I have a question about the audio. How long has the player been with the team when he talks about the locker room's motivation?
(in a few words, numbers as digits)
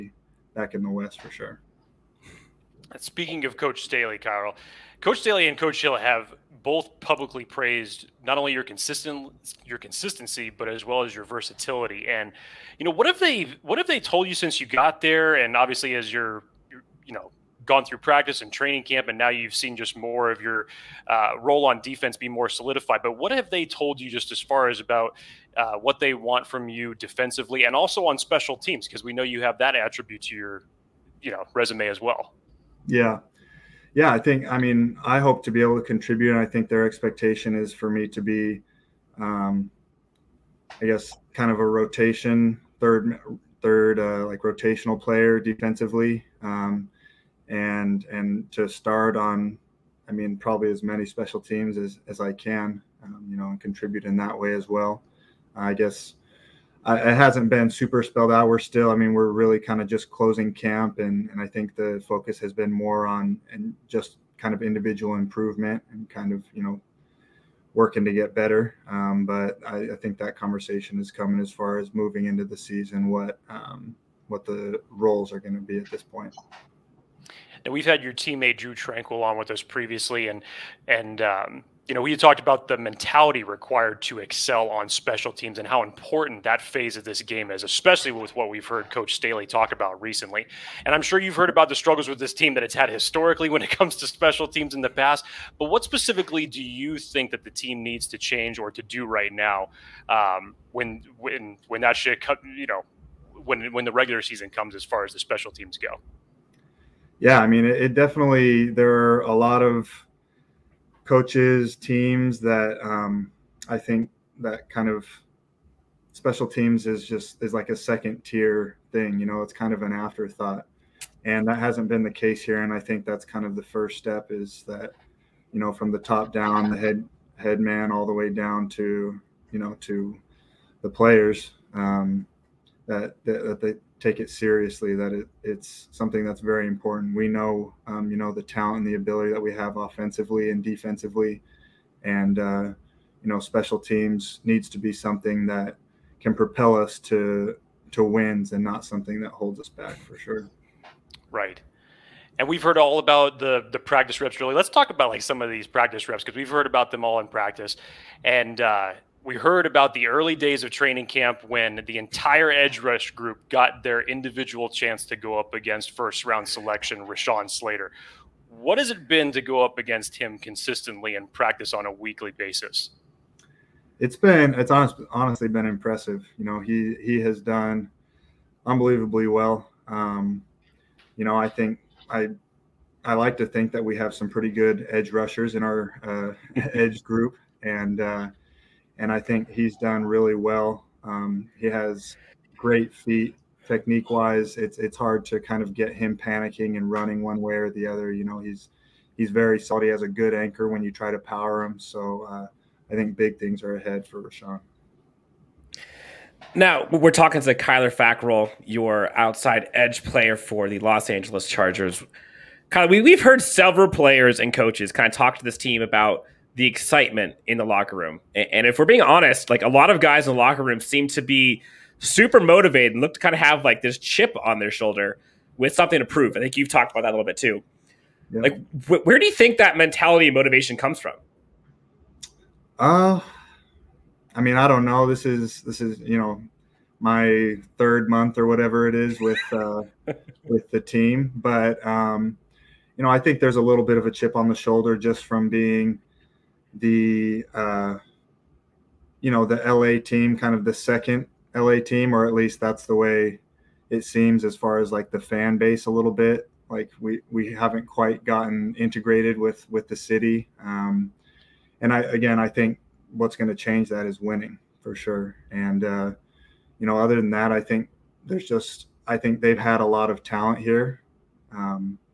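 third month.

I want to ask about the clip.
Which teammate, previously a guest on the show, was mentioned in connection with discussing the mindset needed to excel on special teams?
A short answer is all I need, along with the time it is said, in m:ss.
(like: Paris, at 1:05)
Drue Tranquill, at 1:18.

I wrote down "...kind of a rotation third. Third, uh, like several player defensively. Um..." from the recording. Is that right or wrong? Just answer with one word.
wrong.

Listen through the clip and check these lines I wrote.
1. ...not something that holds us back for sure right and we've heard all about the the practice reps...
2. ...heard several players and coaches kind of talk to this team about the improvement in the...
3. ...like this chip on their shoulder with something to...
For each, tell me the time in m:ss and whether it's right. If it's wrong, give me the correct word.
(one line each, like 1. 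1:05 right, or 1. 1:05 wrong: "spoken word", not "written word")
1. 2:28 right
2. 3:33 wrong: "excitement", not "improvement"
3. 3:43 right.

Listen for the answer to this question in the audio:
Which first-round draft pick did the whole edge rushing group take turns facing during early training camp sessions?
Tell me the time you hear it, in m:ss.
2:47.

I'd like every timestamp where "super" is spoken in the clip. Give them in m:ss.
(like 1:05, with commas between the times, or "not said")
0:57, 3:41.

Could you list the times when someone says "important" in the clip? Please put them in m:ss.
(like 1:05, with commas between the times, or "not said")
1:25, 2:16.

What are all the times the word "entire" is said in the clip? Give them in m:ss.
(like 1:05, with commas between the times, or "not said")
2:41.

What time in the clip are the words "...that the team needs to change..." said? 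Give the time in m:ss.
1:37.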